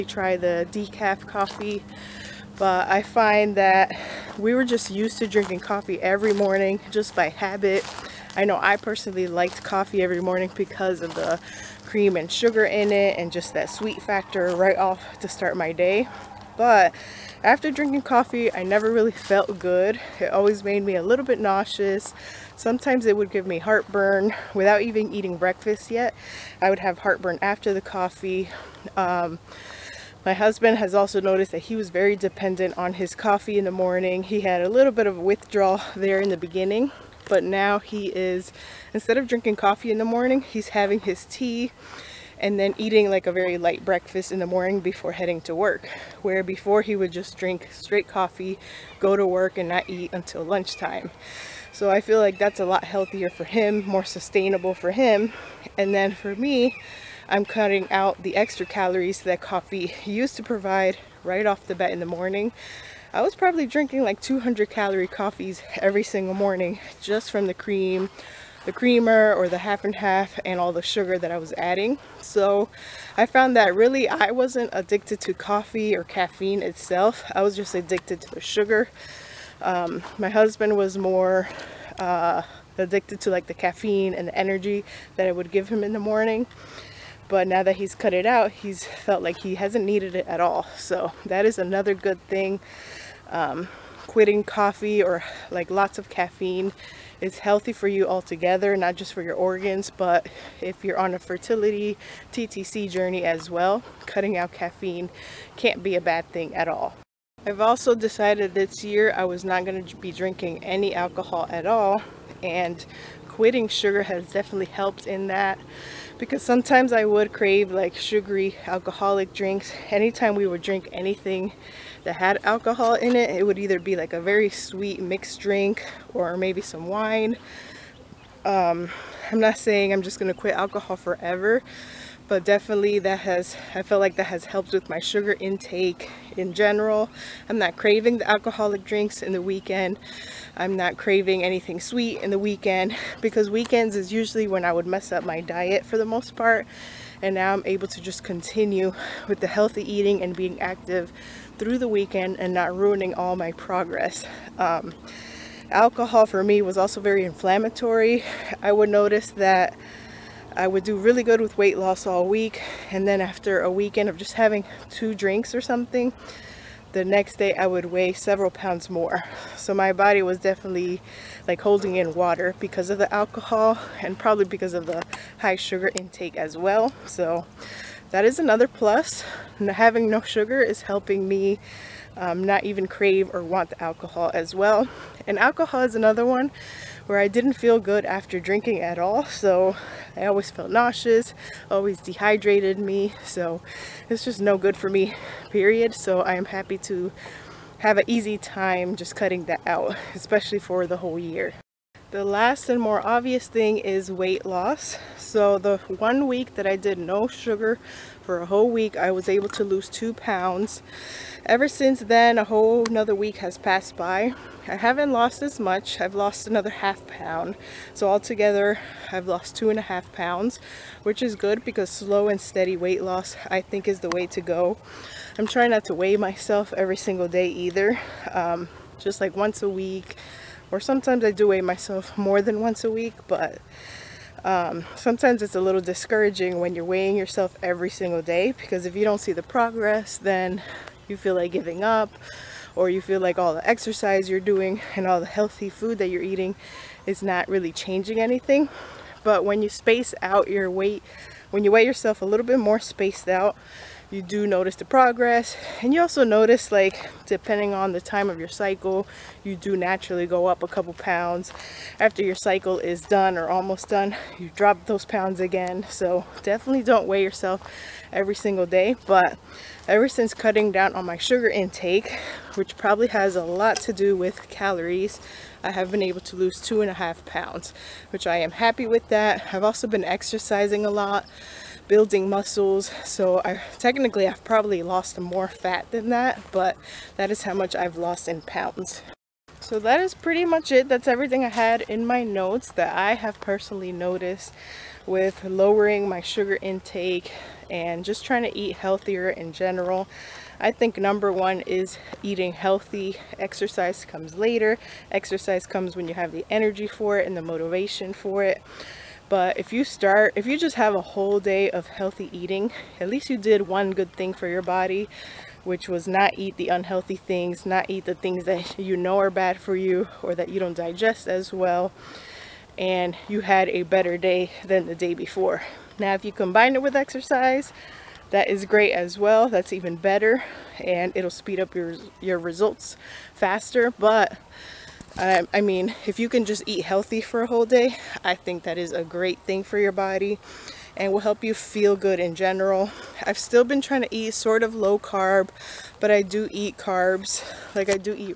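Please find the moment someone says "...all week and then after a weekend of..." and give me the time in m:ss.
2:42.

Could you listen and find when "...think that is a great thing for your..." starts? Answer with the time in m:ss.
5:38.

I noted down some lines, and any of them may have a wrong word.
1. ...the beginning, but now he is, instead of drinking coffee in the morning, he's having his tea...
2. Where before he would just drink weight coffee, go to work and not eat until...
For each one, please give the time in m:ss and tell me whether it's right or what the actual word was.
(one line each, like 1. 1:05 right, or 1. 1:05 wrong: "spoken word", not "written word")
1. 0:36 right
2. 0:46 wrong: "straight", not "weight".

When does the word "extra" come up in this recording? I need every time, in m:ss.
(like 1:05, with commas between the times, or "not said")
0:58.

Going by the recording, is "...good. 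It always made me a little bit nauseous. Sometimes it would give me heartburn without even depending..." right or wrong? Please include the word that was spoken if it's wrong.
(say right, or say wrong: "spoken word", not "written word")
wrong: "eating", not "depending".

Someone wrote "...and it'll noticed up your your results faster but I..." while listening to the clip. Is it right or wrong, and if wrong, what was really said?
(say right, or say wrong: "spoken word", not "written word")
wrong: "speed", not "noticed".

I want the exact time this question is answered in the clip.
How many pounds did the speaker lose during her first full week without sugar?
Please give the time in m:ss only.
3:29.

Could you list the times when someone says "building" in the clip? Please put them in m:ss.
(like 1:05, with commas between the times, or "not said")
4:41.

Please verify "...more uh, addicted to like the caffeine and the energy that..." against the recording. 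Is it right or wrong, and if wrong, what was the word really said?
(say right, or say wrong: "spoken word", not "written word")
right.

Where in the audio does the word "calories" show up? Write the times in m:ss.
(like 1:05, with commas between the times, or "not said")
0:58, 1:04, 4:34.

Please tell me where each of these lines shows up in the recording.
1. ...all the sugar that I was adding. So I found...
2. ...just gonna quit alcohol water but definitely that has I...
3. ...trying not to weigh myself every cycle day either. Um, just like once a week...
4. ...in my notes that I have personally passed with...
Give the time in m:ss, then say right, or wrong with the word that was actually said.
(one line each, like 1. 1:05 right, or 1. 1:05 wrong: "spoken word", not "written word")
1. 1:10 right
2. 2:10 wrong: "forever", not "water"
3. 3:45 wrong: "single", not "cycle"
4. 4:51 wrong: "noticed", not "passed".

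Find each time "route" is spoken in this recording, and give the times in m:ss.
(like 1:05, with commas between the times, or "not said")
not said.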